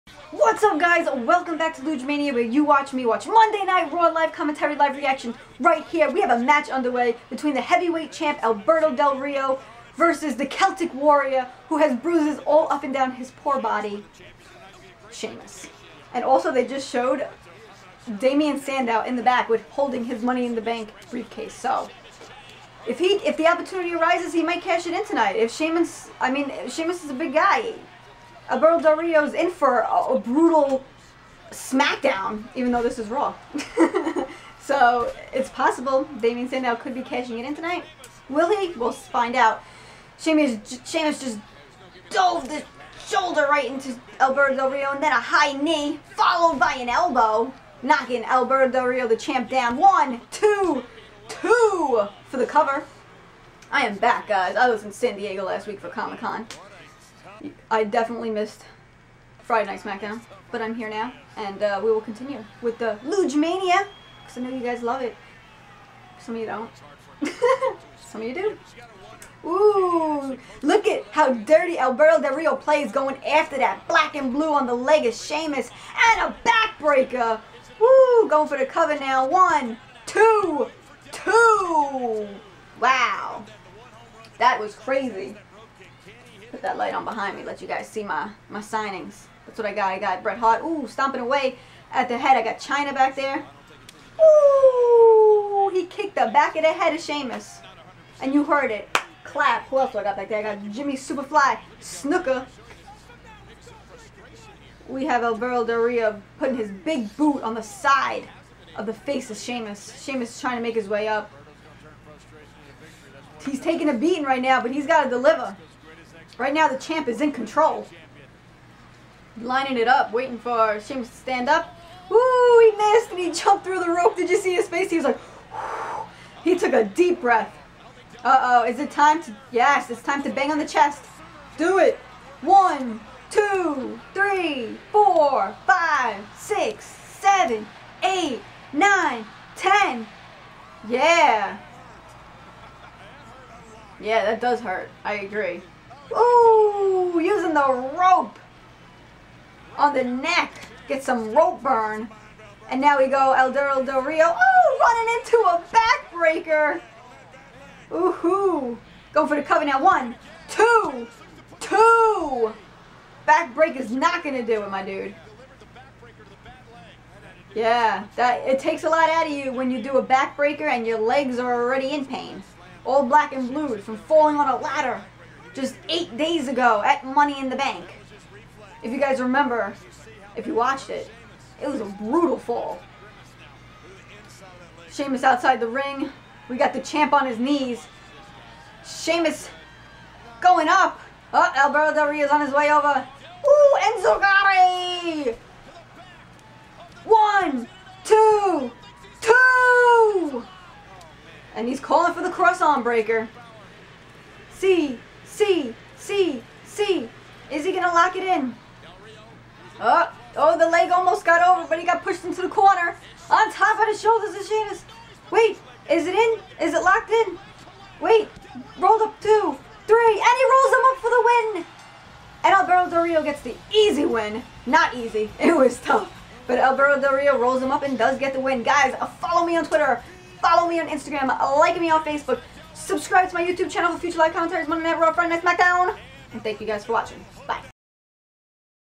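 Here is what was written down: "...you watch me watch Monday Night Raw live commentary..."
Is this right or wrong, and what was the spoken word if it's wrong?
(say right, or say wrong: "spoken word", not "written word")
right.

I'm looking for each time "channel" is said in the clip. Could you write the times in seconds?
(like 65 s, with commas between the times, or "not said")
233 s.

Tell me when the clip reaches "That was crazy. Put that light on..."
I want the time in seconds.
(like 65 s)
84 s.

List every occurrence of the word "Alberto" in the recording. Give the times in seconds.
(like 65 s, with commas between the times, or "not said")
8 s, 28 s, 44 s, 48 s, 71 s, 191 s, 222 s, 226 s.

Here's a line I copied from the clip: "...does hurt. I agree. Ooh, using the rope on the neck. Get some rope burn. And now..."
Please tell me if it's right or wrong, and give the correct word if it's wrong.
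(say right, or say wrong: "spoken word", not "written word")
right.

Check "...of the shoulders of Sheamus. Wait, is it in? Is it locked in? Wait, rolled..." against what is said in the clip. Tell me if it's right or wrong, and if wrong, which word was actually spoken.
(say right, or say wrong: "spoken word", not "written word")
right.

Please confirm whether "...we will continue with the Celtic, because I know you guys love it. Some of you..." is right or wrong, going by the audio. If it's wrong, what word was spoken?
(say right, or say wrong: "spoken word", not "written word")
wrong: "Lugemania", not "Celtic".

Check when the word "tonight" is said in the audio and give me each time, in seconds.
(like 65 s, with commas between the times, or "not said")
25 s, 37 s.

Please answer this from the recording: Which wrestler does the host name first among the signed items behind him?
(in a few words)
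Bret Hart.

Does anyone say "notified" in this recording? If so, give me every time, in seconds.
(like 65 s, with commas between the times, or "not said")
not said.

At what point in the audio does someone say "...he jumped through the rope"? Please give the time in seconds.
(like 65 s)
123 s.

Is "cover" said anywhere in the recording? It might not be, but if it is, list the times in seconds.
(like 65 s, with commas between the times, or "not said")
52 s, 78 s, 159 s.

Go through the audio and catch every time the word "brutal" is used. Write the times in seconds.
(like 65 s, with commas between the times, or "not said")
30 s, 181 s.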